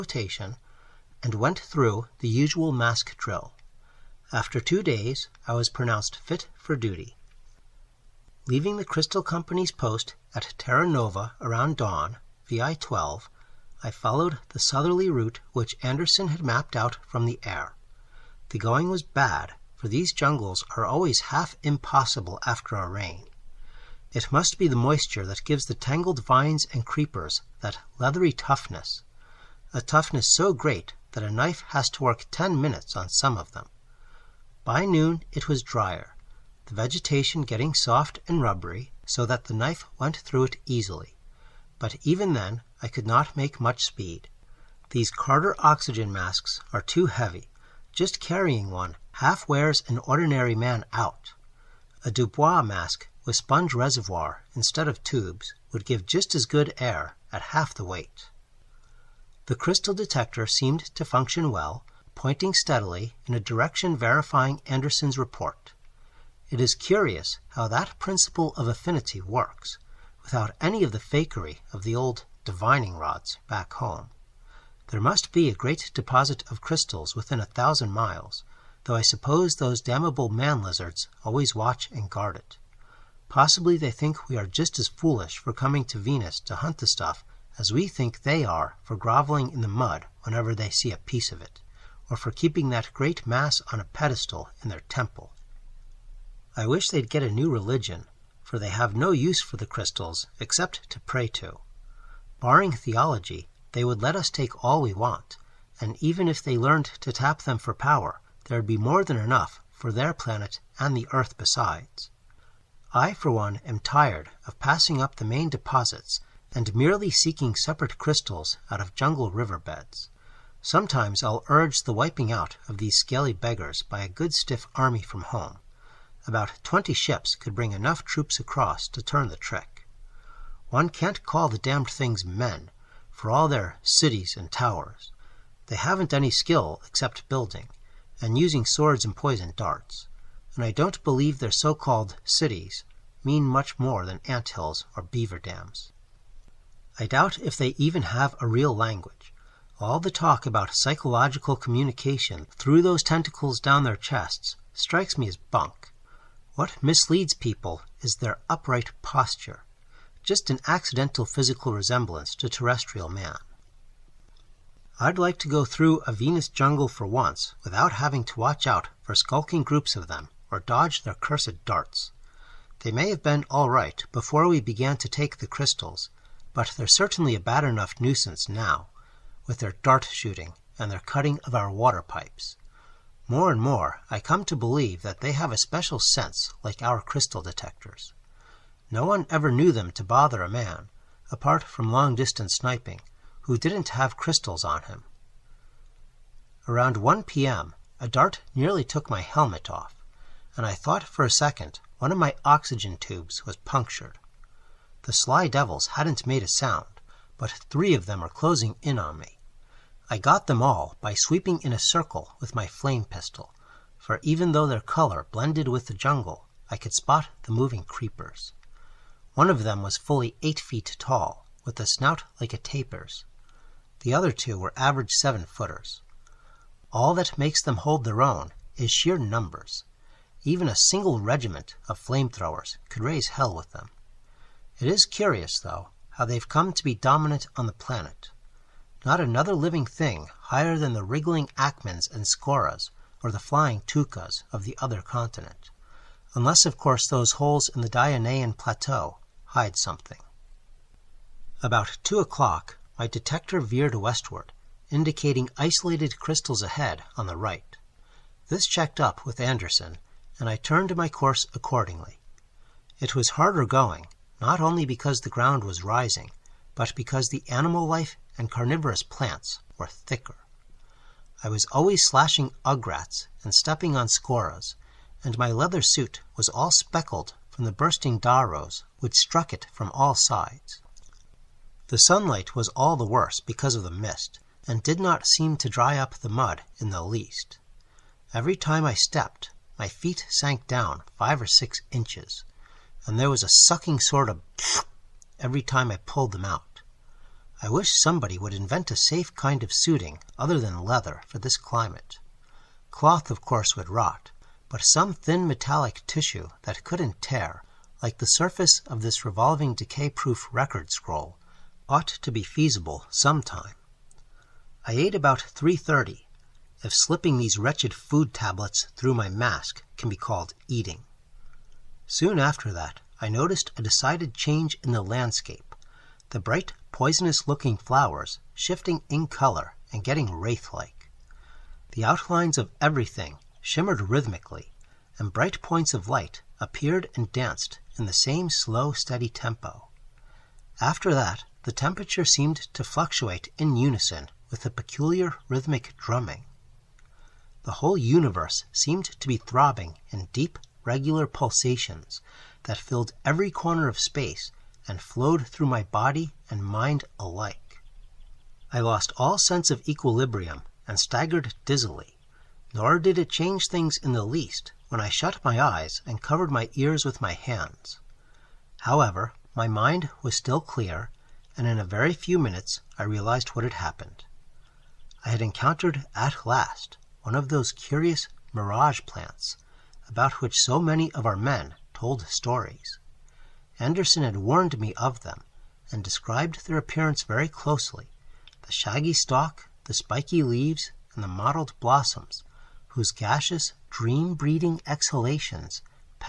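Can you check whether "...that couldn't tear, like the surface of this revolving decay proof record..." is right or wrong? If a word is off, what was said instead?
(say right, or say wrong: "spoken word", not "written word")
right.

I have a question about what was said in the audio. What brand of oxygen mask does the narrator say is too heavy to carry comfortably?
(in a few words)
Carter.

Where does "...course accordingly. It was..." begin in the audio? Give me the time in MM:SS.
04:21.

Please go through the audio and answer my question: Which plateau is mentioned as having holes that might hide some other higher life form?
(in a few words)
Dionaean plateau.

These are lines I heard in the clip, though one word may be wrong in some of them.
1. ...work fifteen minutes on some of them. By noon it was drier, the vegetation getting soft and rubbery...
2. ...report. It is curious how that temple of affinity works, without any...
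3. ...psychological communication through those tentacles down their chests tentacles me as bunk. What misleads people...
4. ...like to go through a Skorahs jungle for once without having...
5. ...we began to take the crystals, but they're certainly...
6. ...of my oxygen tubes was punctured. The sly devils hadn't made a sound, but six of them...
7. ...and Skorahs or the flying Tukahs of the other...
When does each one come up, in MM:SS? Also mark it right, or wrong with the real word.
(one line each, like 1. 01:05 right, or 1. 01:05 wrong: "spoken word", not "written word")
1. 00:32 wrong: "ten", not "fifteen"
2. 01:05 wrong: "principle", not "temple"
3. 02:30 wrong: "strikes", not "tentacles"
4. 02:45 wrong: "Venus", not "Skorahs"
5. 02:54 right
6. 03:22 wrong: "three", not "six"
7. 04:02 right.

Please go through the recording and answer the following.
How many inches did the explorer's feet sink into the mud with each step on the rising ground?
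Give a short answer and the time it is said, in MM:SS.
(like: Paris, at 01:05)
5 or 6 inches, at 04:51.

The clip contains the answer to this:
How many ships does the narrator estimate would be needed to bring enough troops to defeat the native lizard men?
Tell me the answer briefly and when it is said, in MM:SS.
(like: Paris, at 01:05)
20, at 02:06.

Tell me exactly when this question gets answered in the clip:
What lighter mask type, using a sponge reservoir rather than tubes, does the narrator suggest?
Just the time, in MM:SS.
00:52.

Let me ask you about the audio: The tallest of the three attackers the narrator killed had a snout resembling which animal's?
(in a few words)
A tapir.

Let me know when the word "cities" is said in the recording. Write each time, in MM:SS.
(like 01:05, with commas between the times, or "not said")
02:13, 02:22.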